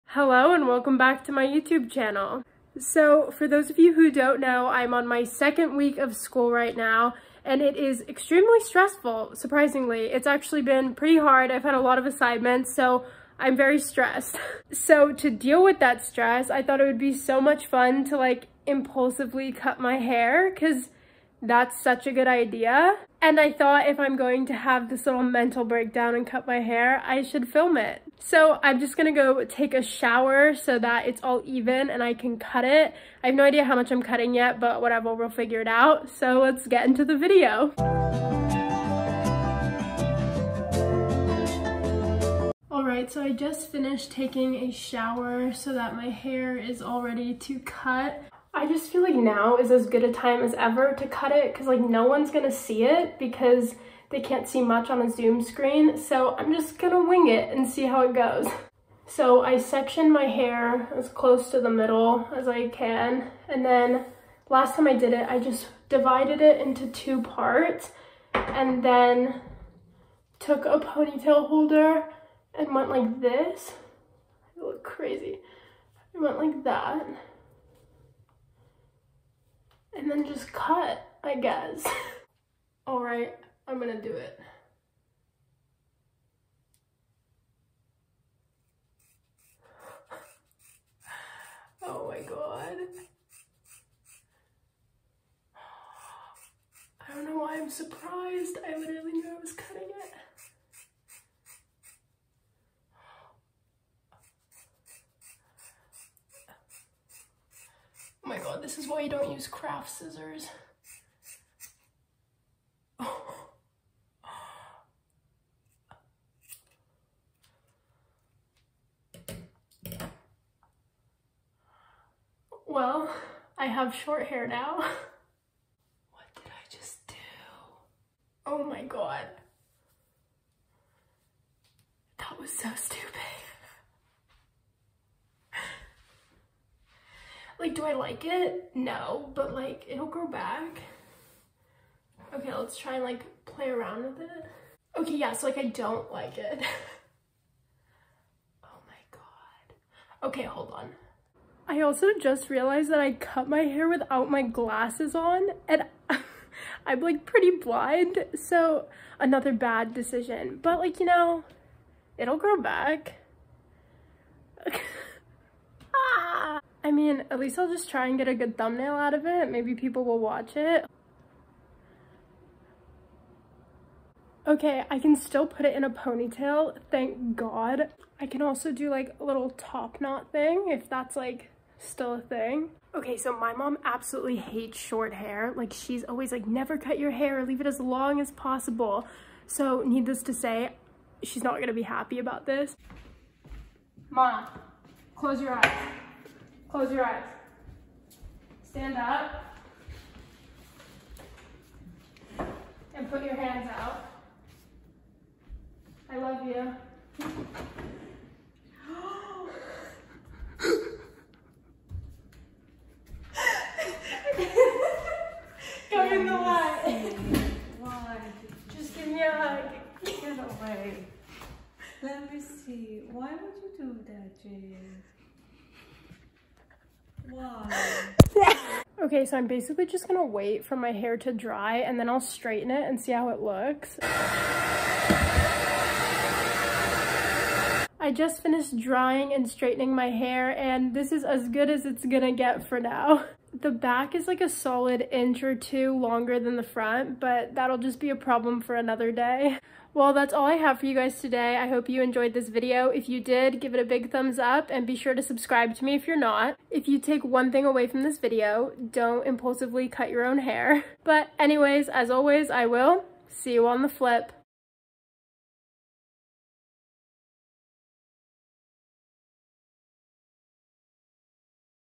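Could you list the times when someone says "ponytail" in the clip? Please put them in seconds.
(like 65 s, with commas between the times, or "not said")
70 s, 175 s.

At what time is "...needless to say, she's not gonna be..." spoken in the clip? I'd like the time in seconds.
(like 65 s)
189 s.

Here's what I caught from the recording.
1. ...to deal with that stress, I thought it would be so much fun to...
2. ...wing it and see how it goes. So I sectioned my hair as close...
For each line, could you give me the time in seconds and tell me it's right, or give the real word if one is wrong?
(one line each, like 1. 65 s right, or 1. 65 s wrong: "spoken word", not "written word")
1. 15 s right
2. 57 s right.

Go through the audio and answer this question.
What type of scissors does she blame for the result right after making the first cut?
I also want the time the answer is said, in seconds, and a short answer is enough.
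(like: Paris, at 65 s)
Craft scissors, at 109 s.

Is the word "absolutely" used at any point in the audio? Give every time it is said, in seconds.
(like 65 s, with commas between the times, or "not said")
183 s.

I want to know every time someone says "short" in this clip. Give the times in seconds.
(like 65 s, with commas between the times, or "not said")
123 s, 184 s.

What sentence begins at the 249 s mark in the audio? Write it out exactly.
Well, that's all I have for you guys today.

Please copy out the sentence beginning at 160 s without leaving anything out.
But like, you know, it'll grow back.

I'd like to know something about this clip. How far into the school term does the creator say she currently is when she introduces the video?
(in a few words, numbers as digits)
Second week.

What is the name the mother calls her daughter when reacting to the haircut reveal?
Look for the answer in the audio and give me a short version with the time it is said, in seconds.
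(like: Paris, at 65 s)
Jade, at 224 s.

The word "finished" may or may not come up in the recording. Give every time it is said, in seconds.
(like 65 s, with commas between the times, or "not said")
43 s, 238 s.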